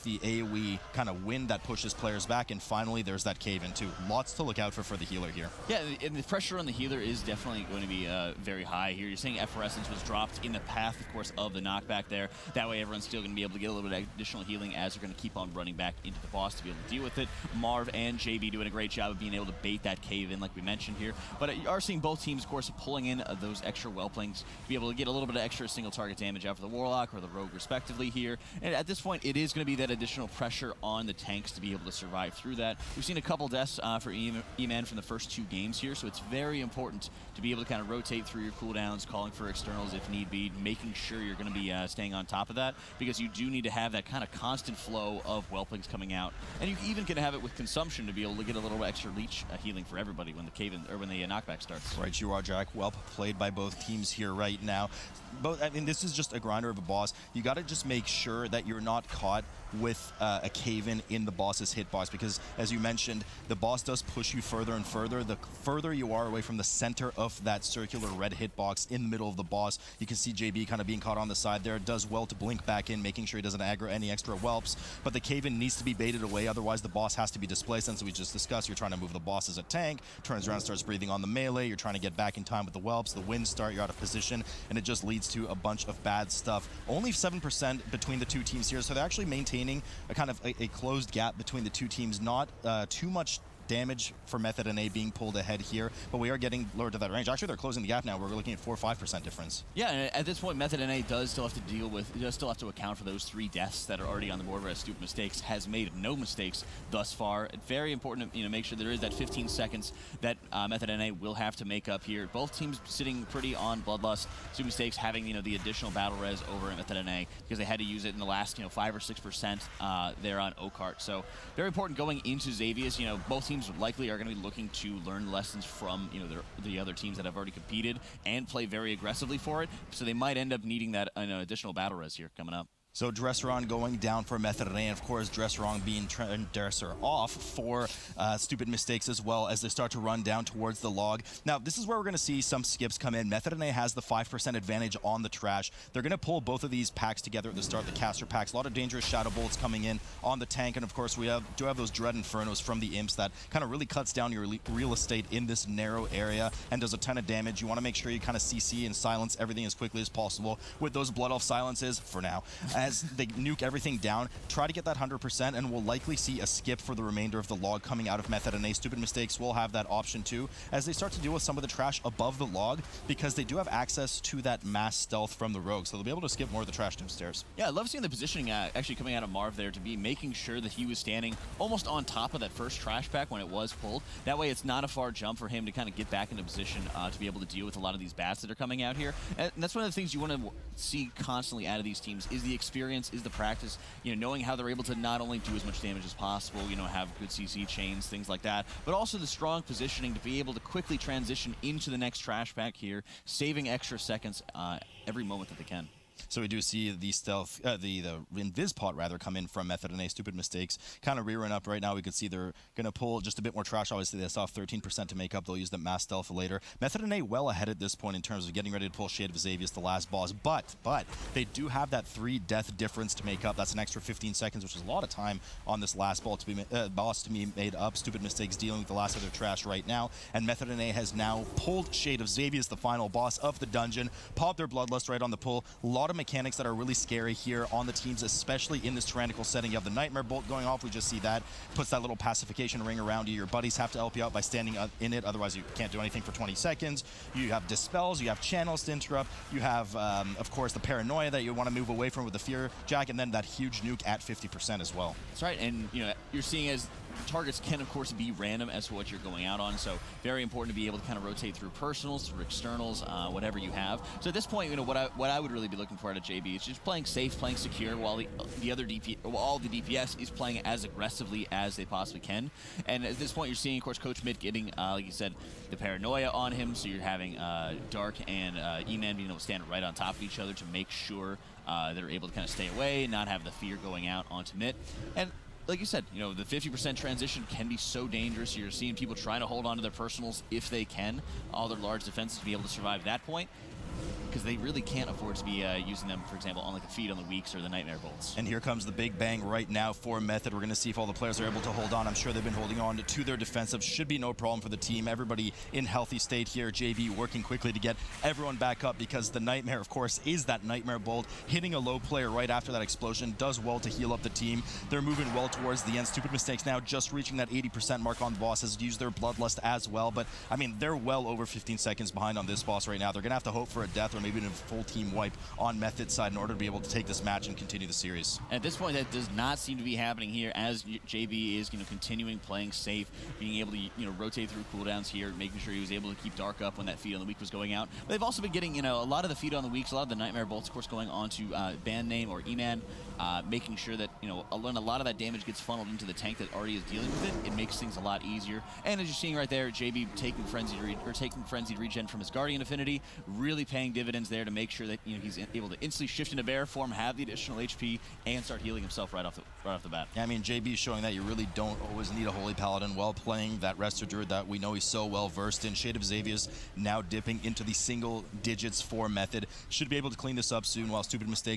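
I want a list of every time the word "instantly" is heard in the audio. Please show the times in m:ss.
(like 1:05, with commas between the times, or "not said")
5:55.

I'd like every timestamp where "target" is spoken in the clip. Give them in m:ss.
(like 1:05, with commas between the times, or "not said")
0:25, 4:17.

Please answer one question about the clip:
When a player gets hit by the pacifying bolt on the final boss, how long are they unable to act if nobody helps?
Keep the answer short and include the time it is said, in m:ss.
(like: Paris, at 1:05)
20 seconds, at 4:06.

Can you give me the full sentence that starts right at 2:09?
So they might end up needing that you know, additional battle res here coming up.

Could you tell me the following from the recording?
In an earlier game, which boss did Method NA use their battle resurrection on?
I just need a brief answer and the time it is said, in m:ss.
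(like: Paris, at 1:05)
Oakheart, at 2:00.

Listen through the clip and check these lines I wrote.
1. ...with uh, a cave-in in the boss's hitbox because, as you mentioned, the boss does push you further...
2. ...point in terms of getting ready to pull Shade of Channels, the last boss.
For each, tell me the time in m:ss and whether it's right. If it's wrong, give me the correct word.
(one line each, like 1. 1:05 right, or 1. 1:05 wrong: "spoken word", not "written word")
1. 0:59 right
2. 3:37 wrong: "Xavius", not "Channels".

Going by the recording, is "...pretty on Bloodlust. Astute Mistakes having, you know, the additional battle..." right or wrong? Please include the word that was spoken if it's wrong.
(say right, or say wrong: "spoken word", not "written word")
right.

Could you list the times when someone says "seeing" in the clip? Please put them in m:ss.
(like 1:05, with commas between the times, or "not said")
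0:21, 2:57, 4:16, 4:33, 4:48, 5:49.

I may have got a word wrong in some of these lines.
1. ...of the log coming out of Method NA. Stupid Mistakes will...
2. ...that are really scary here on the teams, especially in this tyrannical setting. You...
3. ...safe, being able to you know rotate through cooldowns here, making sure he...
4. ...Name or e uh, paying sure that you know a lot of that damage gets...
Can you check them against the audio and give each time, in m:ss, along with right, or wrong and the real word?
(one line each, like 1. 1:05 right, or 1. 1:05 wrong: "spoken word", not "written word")
1. 2:47 right
2. 3:56 right
3. 5:32 right
4. 5:42 wrong: "making", not "paying".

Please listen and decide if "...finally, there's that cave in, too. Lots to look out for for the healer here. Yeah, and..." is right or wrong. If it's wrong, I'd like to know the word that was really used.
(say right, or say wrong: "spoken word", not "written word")
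right.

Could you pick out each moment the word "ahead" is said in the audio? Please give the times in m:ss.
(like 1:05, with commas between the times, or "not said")
1:35, 3:37.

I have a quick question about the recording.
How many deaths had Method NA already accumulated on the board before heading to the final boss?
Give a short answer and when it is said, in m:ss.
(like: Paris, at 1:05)
3, at 1:43.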